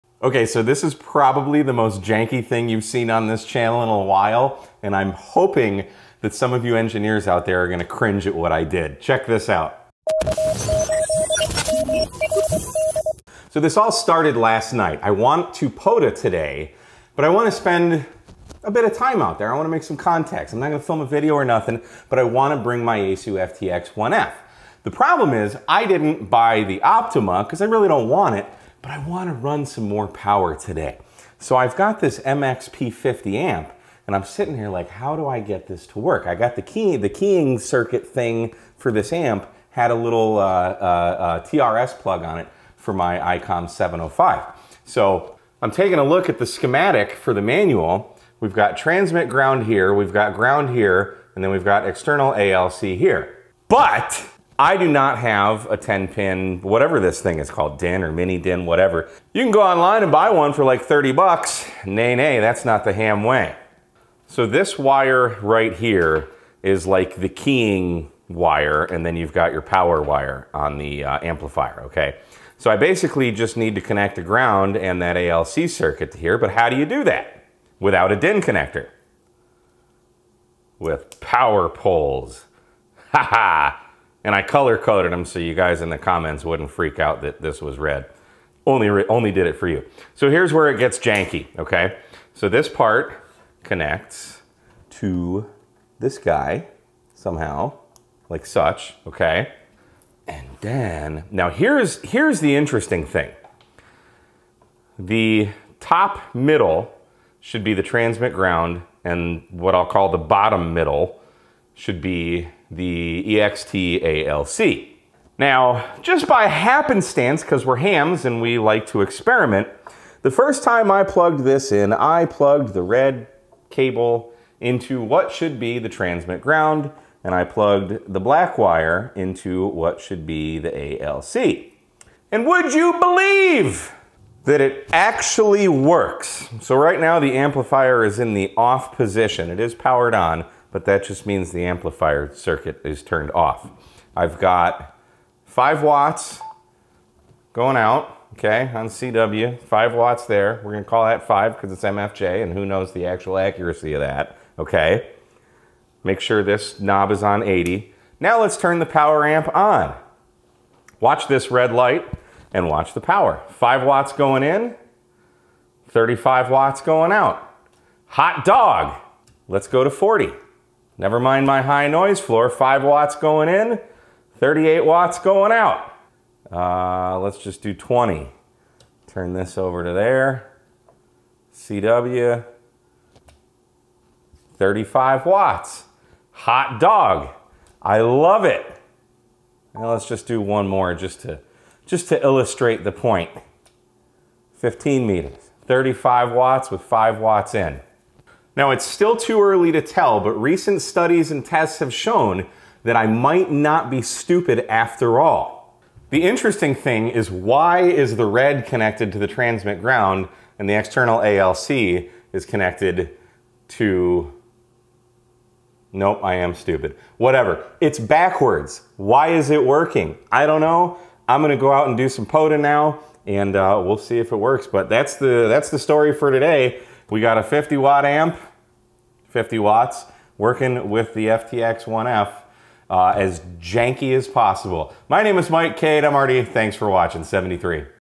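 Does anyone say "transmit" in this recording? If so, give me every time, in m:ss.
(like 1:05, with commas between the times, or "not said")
0:48, 1:47, 2:05, 3:29.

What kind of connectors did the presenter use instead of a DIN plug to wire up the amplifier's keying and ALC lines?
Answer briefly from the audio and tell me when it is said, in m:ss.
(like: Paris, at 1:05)
Power poles, at 1:21.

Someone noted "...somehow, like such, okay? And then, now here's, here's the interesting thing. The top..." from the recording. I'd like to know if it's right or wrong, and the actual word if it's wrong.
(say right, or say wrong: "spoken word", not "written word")
right.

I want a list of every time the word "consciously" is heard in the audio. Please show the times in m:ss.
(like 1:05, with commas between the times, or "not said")
not said.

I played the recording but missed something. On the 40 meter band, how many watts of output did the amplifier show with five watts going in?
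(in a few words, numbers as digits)
38 watts.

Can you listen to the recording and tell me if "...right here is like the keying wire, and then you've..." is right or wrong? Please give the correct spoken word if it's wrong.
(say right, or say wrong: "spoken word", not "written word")
right.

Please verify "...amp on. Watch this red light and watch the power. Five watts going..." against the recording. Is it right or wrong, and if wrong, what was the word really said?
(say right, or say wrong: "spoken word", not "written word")
right.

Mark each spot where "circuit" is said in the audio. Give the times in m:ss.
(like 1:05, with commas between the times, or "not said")
0:37, 1:15, 2:22.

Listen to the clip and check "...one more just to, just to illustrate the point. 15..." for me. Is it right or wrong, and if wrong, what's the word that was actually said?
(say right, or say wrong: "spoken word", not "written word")
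right.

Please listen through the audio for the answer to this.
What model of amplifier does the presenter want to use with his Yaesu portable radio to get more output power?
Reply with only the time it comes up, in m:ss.
0:32.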